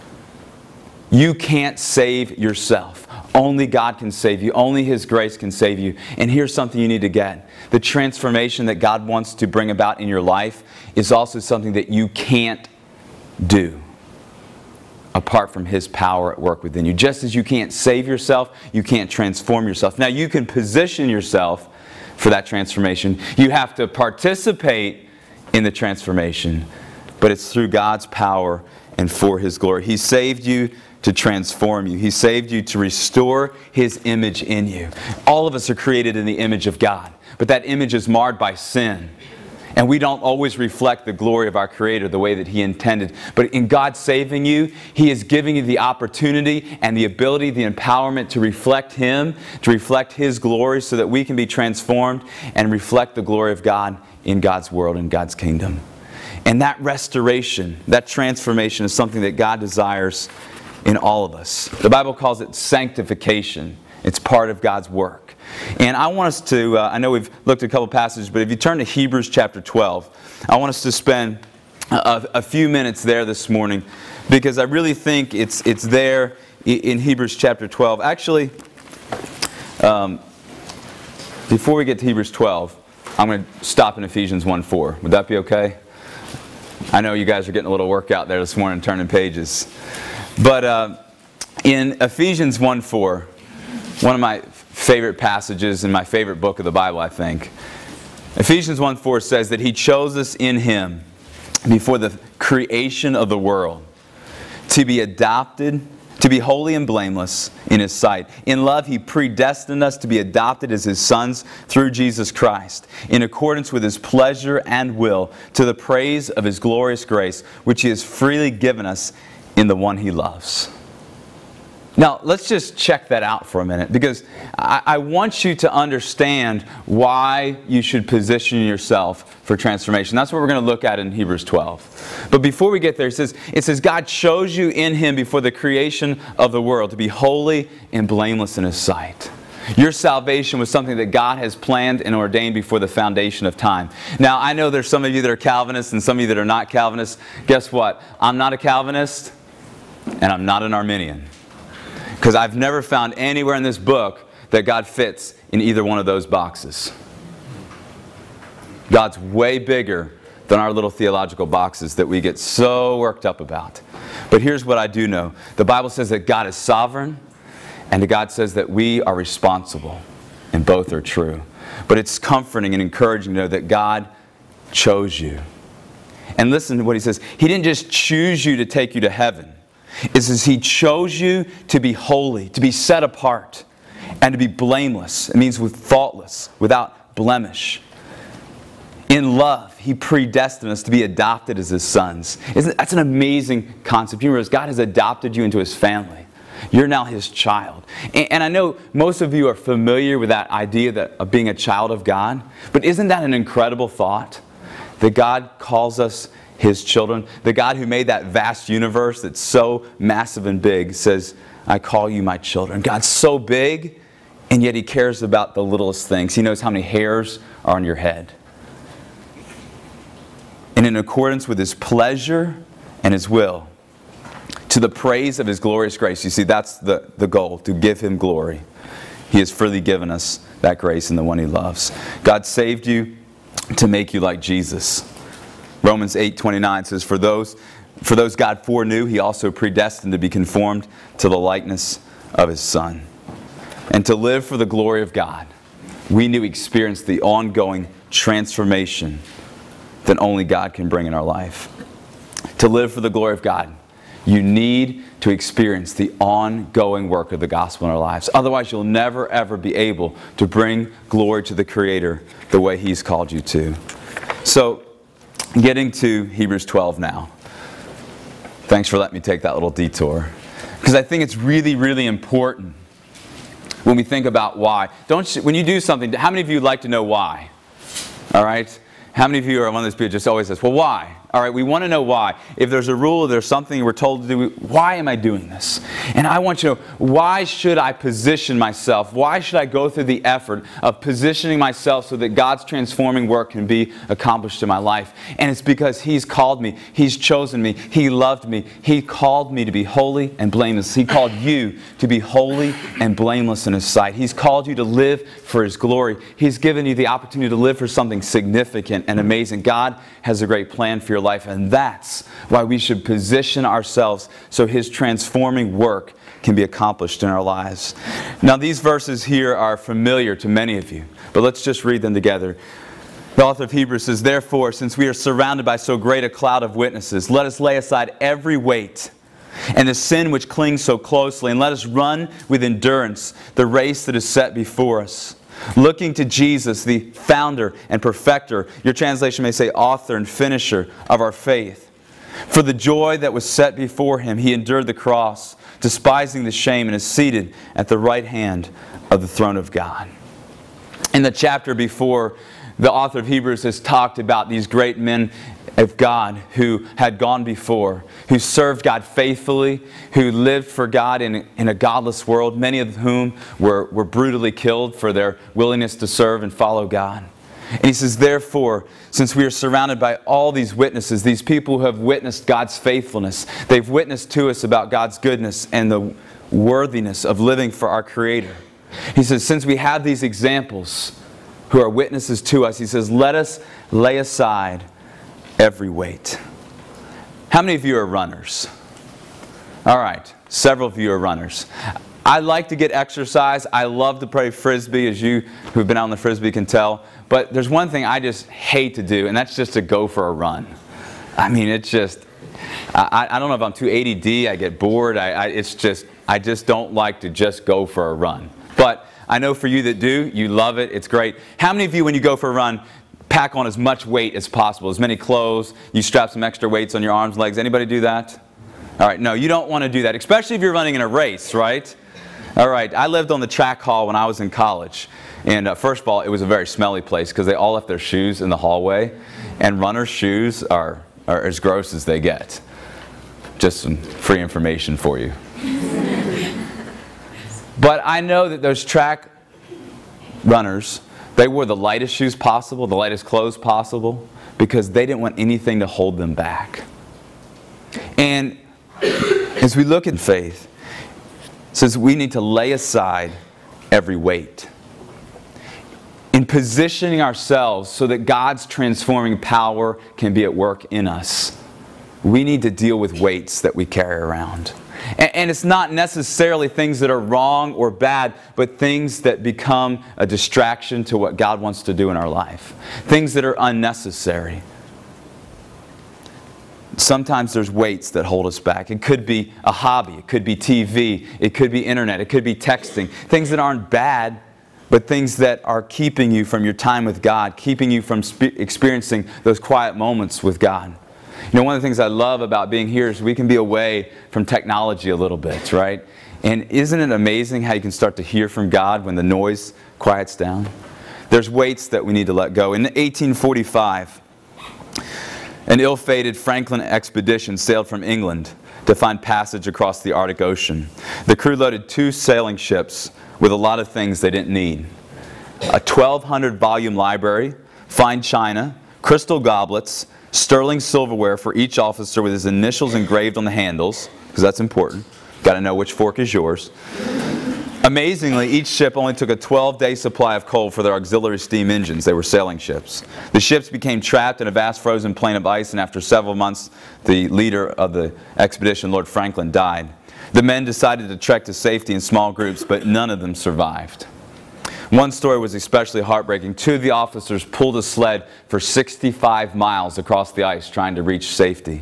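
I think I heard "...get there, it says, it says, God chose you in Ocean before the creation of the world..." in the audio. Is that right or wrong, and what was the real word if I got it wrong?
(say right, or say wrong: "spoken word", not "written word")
wrong: "Him", not "Ocean".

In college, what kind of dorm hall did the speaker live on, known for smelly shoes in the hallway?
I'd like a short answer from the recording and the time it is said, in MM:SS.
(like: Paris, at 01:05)
The track hall, at 07:03.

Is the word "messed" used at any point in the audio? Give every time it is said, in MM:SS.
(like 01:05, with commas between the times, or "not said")
not said.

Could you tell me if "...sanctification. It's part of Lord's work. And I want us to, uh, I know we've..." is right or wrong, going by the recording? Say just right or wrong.
wrong.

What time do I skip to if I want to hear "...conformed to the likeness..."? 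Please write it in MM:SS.
04:00.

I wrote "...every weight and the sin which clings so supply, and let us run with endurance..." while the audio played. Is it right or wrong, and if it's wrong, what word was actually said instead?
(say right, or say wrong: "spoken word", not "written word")
wrong: "closely", not "supply".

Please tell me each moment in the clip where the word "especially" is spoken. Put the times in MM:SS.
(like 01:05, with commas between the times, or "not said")
07:00, 09:05.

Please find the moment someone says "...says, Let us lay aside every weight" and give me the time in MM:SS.
06:22.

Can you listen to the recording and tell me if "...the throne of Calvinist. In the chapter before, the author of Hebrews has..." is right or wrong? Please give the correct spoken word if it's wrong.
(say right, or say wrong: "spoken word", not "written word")
wrong: "God", not "Calvinist".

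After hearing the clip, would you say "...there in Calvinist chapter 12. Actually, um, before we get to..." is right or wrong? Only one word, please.
wrong.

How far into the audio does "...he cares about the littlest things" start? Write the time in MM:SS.
03:34.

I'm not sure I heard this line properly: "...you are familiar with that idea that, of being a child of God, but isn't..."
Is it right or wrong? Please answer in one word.
right.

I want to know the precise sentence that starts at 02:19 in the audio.
Your salvation was something that God has planned and ordained before the foundation of time.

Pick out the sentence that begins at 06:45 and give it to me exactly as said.
I, I, it's just, I just don't like to just go for a run.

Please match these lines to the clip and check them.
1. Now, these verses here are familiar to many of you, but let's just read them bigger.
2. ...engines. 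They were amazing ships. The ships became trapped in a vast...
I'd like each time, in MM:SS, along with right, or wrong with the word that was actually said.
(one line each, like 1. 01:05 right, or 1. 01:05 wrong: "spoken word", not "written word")
1. 05:18 wrong: "together", not "bigger"
2. 08:51 wrong: "sailing", not "amazing".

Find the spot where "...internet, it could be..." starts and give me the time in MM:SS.
08:01.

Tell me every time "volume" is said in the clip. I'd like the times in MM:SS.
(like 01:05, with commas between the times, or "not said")
08:36.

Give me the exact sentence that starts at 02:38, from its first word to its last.
God's way bigger than our little theological boxes that we get so worked up about.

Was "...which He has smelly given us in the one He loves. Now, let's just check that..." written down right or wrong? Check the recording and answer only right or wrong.
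wrong.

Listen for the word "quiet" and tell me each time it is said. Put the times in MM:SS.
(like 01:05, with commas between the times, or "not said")
08:09, 08:19.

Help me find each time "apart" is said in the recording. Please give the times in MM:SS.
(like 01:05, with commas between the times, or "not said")
00:15, 03:03.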